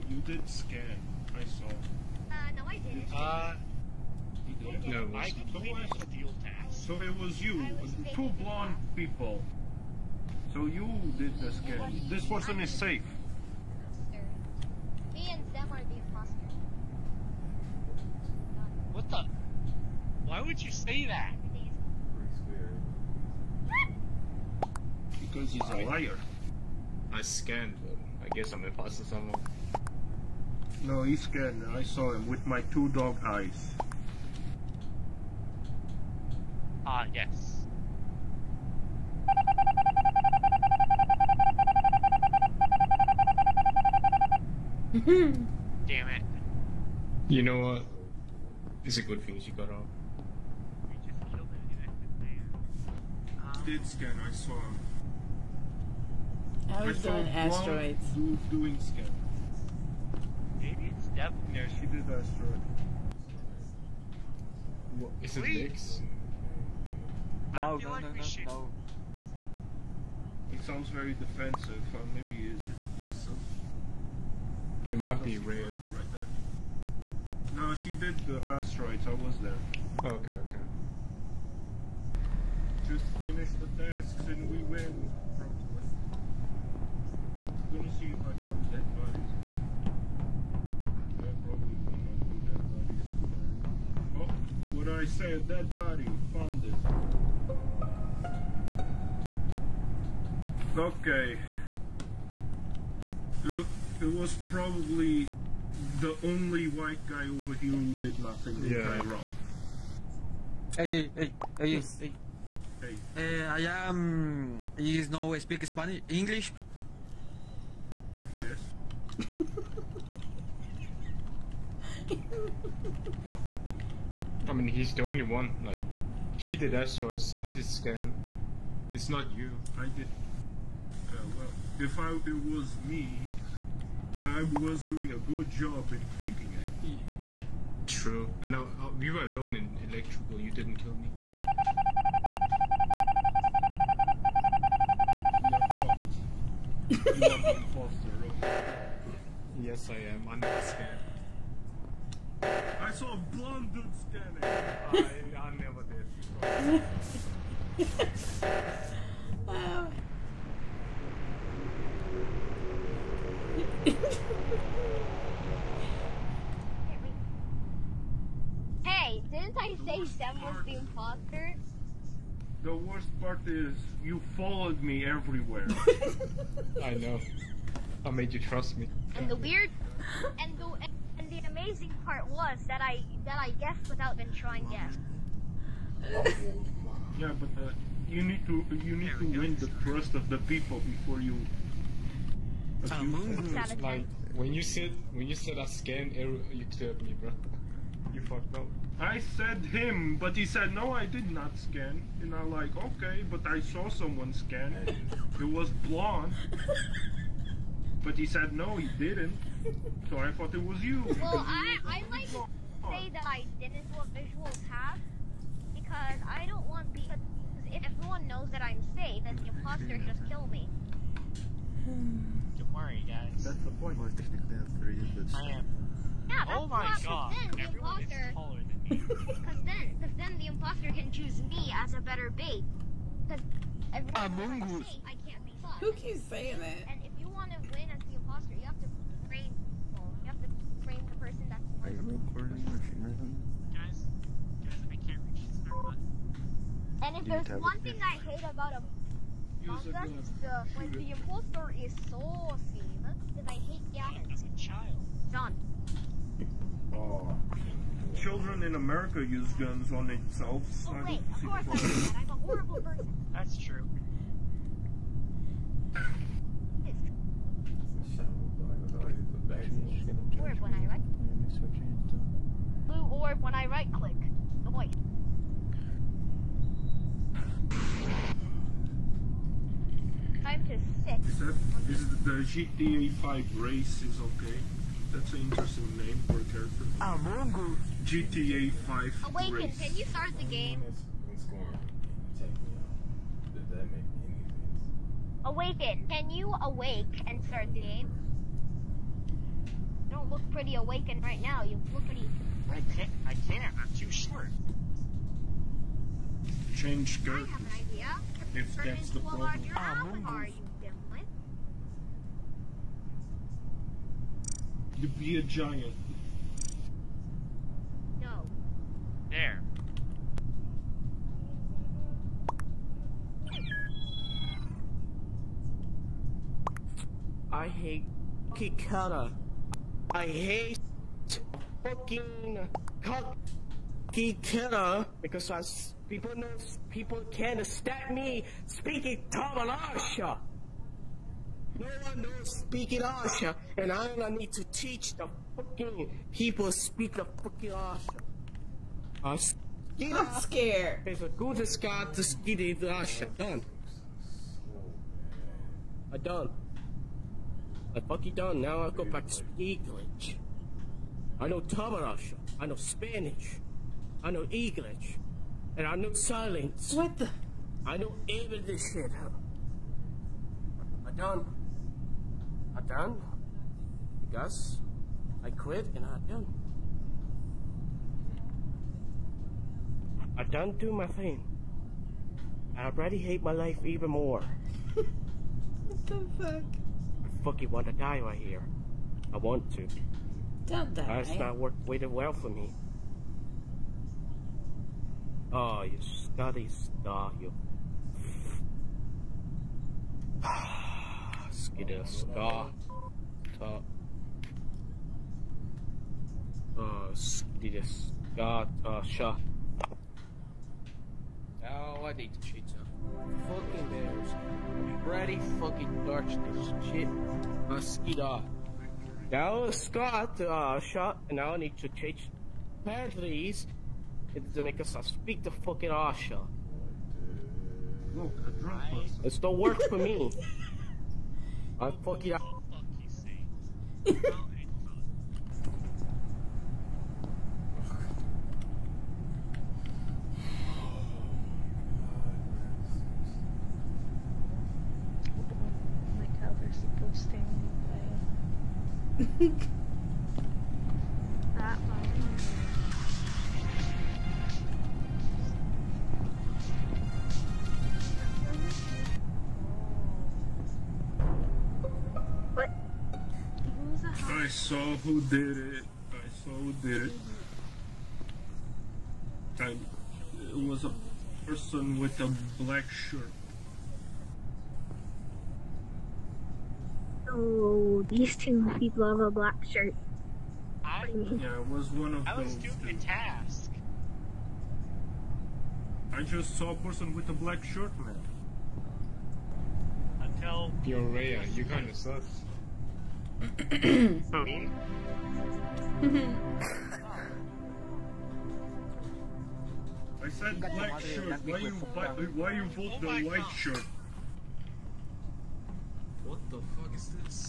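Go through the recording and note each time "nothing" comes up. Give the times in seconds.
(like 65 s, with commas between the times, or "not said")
108 s.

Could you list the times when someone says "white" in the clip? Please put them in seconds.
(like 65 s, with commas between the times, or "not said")
106 s, 503 s.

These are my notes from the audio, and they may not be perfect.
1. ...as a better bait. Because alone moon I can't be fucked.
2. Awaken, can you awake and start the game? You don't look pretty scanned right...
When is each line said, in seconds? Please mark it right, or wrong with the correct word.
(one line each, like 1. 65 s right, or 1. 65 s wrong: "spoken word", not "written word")
1. 231 s wrong: "everyone", not "alone"
2. 295 s wrong: "awakened", not "scanned".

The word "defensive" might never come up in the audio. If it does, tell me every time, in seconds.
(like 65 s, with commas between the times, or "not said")
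71 s.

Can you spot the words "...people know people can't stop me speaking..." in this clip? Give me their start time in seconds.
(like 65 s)
336 s.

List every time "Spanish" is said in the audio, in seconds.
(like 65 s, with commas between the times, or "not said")
115 s, 362 s.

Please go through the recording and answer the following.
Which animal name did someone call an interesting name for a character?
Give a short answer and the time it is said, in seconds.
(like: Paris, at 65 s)
Mongoose, at 287 s.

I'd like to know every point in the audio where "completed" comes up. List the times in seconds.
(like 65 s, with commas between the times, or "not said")
5 s.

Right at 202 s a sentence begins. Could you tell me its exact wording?
And I'm like, okay, but I saw someone scan it.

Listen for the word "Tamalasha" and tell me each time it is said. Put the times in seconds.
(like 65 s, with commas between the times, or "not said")
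339 s.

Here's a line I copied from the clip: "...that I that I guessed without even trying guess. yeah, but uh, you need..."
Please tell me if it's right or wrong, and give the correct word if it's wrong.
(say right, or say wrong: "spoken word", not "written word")
right.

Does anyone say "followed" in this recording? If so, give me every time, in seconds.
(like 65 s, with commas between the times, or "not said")
174 s.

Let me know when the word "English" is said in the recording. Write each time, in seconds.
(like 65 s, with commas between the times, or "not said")
116 s, 359 s, 364 s.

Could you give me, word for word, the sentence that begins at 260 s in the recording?
oh, wait, of course I did that.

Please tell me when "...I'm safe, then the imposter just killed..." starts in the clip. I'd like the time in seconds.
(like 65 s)
218 s.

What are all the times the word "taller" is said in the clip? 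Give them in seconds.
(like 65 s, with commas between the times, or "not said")
228 s.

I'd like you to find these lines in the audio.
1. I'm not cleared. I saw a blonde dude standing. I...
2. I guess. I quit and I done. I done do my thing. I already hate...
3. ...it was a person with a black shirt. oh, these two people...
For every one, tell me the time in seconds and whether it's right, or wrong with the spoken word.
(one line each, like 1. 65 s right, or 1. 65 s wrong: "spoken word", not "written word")
1. 150 s wrong: "scared", not "cleared"
2. 374 s right
3. 470 s right.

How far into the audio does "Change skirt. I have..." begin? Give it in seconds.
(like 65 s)
306 s.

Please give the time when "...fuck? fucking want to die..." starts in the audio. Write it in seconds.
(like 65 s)
386 s.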